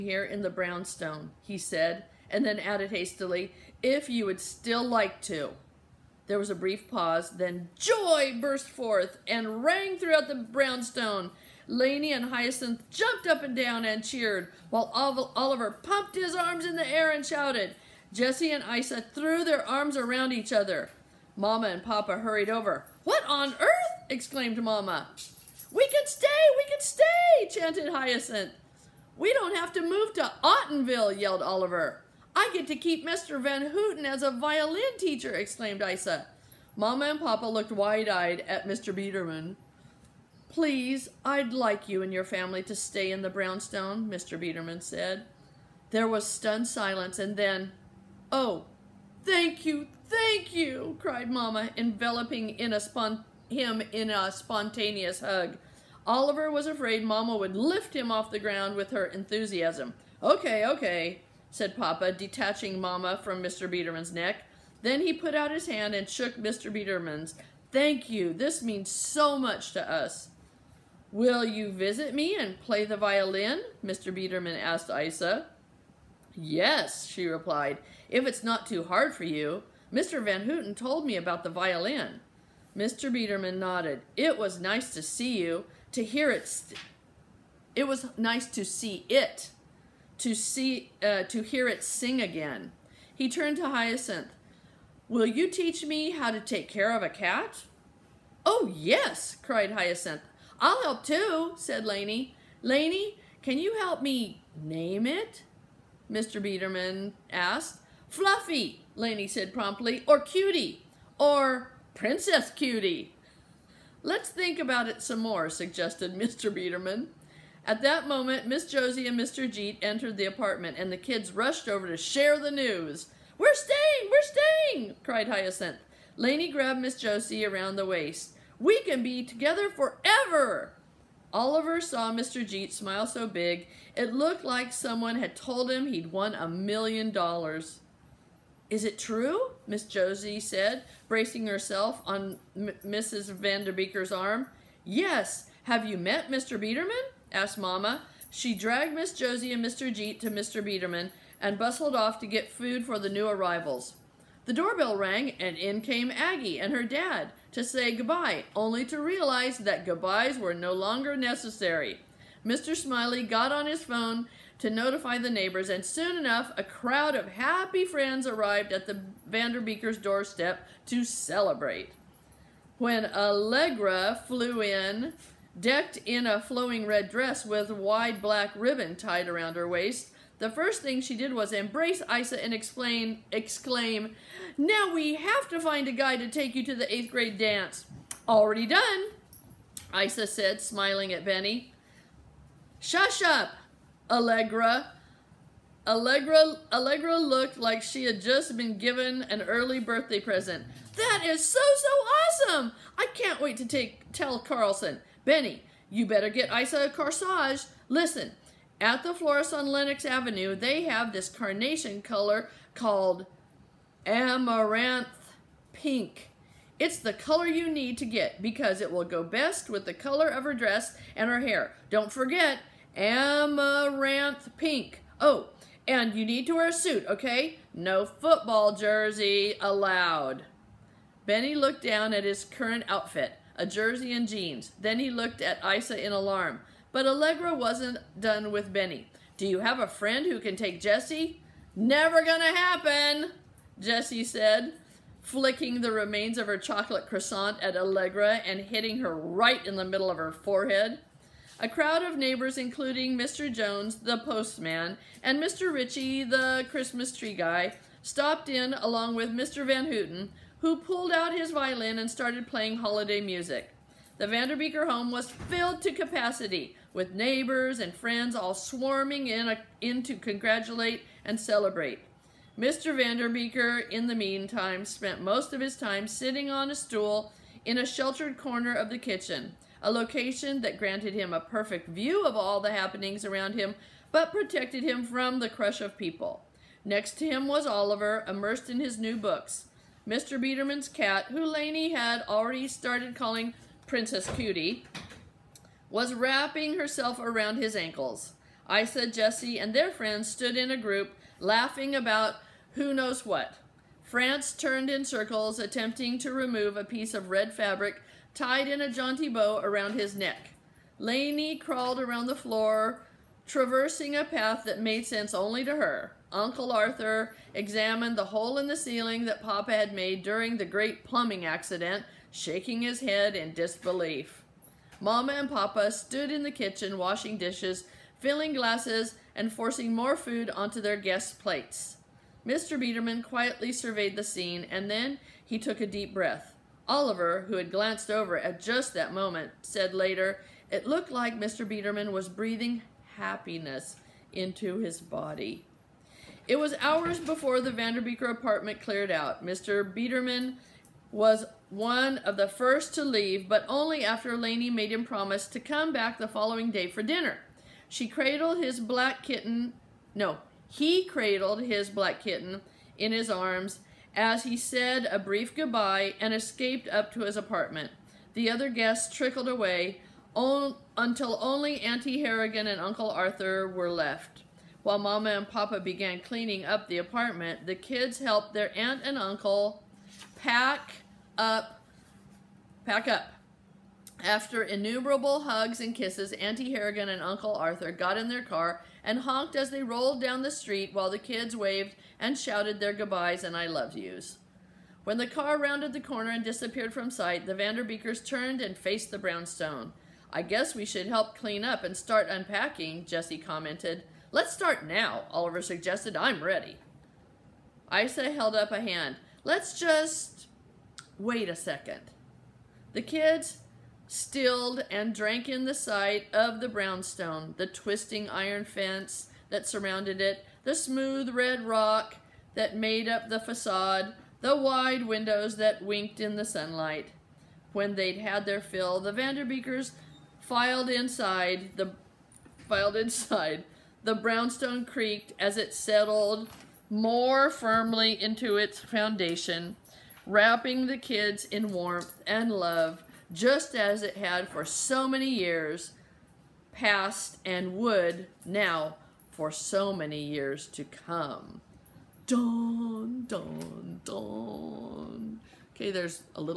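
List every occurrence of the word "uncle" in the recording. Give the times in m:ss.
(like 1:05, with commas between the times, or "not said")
5:16, 6:12, 6:19, 6:27.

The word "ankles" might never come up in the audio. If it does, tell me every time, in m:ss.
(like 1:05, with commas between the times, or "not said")
4:57.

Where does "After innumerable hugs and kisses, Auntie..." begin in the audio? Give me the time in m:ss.
6:24.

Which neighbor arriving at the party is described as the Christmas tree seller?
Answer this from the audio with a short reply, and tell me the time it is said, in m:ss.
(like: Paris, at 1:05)
Mr. Ritchie, at 4:15.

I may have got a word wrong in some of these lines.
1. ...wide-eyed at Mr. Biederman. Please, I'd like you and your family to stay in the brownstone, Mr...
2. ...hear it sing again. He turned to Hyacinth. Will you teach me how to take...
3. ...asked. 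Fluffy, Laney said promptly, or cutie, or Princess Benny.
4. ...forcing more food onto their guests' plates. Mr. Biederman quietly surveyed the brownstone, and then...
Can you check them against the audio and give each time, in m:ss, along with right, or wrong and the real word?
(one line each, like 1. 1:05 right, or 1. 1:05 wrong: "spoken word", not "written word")
1. 0:37 right
2. 1:31 right
3. 1:47 wrong: "Cutie", not "Benny"
4. 5:29 wrong: "scene", not "brownstone".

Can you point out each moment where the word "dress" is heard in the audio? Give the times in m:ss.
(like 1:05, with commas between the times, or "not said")
2:57, 3:40.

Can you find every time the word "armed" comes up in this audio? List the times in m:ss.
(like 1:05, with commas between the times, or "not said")
not said.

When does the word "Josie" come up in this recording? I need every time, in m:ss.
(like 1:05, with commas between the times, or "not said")
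1:58, 2:06, 2:19, 2:29.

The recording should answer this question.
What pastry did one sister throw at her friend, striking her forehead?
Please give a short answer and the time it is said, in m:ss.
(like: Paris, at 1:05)
chocolate croissant, at 4:06.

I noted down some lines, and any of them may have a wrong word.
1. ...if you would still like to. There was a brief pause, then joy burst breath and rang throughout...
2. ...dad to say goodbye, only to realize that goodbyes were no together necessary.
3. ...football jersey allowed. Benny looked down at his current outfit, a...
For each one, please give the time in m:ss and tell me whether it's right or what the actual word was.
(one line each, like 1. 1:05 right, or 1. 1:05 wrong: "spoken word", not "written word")
1. 0:03 wrong: "forth", not "breath"
2. 2:36 wrong: "longer", not "together"
3. 3:48 right.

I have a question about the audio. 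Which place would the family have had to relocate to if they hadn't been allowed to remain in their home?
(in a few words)
Ottenville.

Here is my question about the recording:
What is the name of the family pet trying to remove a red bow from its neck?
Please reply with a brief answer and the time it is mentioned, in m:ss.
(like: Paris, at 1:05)
France, at 5:04.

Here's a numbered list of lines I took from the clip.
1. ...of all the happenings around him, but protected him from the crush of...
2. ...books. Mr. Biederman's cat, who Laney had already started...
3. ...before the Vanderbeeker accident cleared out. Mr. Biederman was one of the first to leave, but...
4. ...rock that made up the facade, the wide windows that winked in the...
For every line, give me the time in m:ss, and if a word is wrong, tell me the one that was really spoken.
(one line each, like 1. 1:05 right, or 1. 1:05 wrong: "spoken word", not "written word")
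1. 4:42 right
2. 4:49 right
3. 5:47 wrong: "apartment", not "accident"
4. 7:01 right.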